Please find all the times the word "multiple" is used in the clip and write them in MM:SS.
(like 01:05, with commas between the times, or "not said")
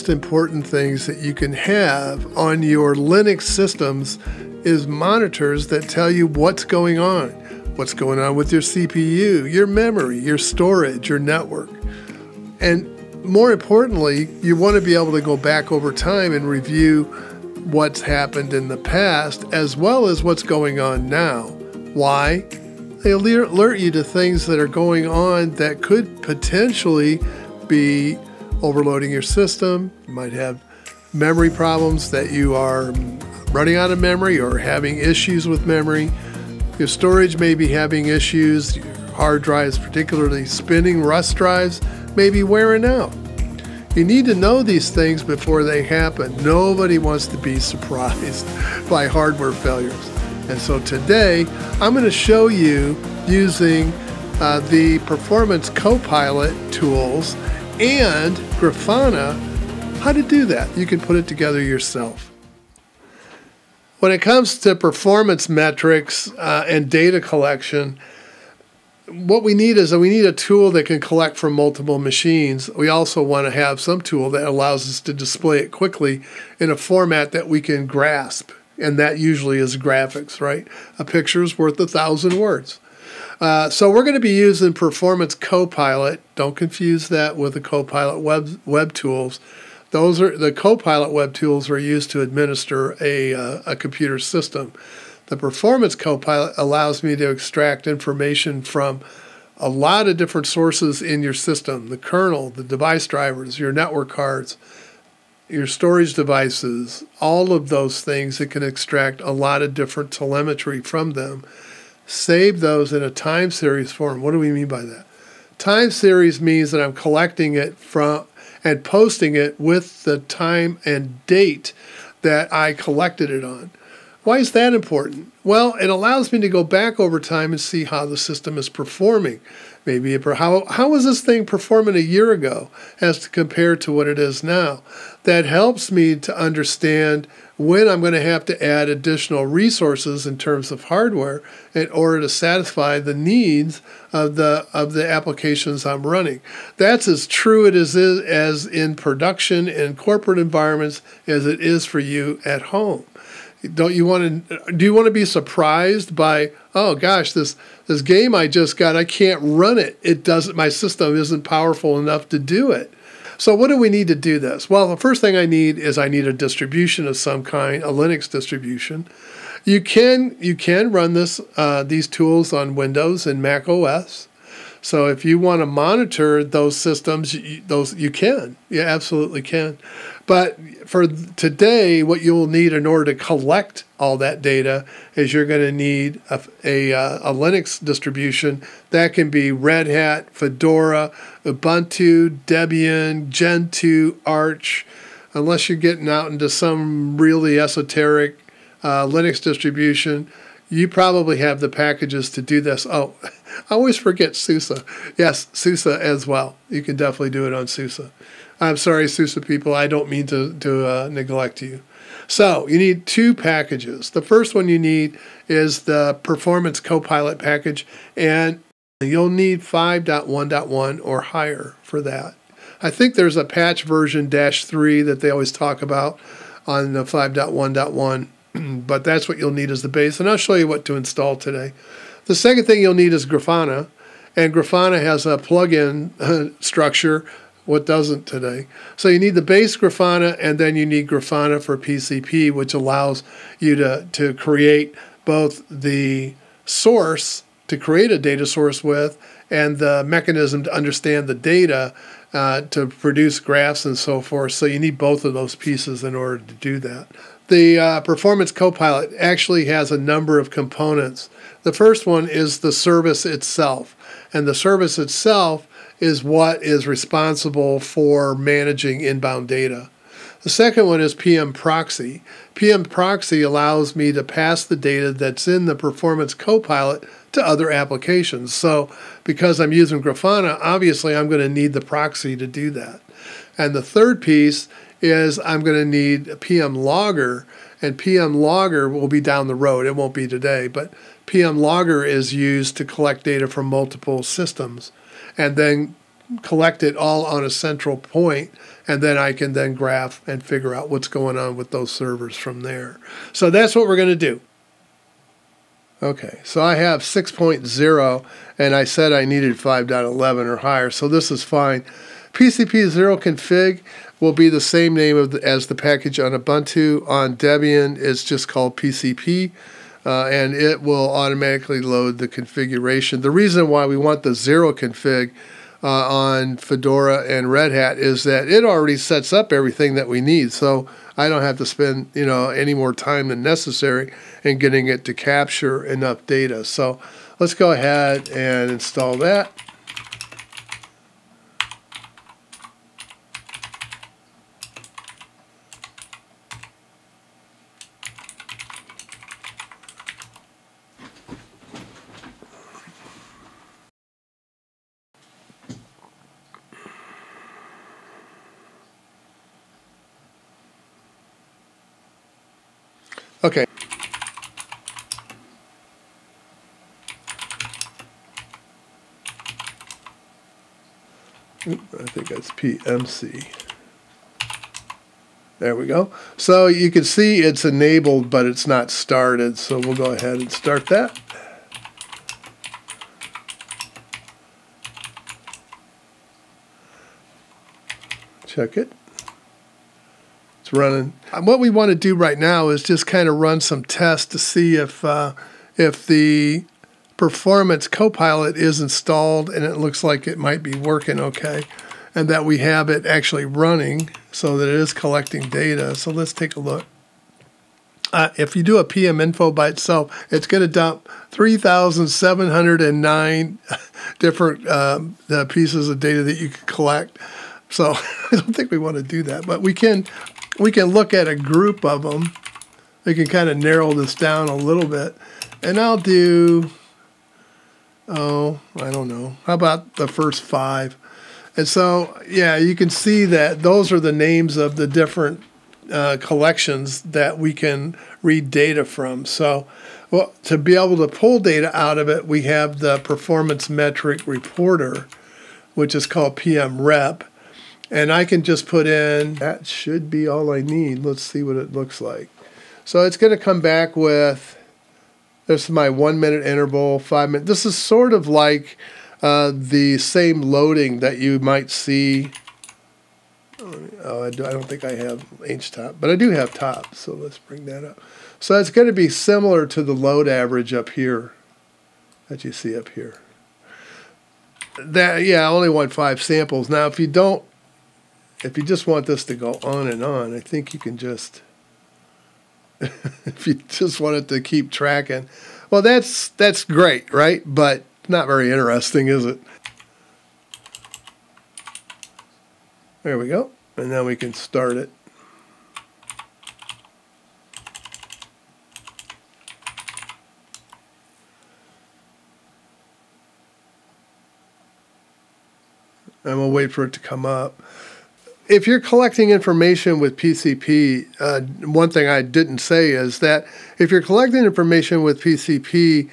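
01:11, 04:53.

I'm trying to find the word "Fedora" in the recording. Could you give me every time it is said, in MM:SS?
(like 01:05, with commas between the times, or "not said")
03:10, 05:26.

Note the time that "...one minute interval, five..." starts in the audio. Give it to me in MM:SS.
07:35.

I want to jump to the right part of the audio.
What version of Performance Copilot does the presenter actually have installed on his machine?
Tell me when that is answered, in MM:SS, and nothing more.
05:07.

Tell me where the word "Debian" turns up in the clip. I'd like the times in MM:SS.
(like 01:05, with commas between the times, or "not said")
03:12, 05:17.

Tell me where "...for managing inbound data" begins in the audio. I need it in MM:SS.
04:27.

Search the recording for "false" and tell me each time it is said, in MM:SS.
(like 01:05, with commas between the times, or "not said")
not said.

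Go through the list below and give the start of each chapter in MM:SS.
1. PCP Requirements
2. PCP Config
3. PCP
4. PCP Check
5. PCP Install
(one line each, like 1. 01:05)
1. 08:28
2. 06:03
3. 01:02
4. 06:31
5. 05:04.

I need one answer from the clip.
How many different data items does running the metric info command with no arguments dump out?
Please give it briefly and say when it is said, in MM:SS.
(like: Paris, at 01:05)
3,709, at 06:51.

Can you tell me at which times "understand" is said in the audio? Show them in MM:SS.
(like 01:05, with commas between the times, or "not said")
02:16, 04:10.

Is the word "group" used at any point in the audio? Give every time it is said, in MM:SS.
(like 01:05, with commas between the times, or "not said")
07:01.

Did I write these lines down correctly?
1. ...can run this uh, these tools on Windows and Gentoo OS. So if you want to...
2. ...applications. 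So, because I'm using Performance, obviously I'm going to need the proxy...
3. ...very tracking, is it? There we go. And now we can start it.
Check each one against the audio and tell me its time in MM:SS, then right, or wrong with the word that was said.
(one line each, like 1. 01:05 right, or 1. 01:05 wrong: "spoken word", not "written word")
1. 02:50 wrong: "Mac", not "Gentoo"
2. 04:37 wrong: "Grafana", not "Performance"
3. 08:08 wrong: "interesting", not "tracking".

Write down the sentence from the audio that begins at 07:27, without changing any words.
And I can just put in, that should be all I need.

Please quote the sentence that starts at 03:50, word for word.
And I'll show you what to install today.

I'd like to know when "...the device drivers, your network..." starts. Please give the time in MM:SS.
01:42.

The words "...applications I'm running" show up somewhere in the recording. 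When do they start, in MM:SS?
02:25.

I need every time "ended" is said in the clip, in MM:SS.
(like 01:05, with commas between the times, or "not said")
not said.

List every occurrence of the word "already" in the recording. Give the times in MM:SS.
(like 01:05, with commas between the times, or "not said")
05:28.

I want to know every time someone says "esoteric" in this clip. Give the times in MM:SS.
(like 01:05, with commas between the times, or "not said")
03:17.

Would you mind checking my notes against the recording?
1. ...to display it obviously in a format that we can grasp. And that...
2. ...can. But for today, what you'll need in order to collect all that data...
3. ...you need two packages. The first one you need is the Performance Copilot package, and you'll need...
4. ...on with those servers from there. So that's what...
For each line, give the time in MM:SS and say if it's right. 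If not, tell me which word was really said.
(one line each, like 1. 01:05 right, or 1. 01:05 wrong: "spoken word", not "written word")
1. 01:15 wrong: "quickly", not "obviously"
2. 02:59 right
3. 03:32 right
4. 05:01 right.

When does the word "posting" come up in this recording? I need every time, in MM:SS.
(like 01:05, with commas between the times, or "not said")
01:58.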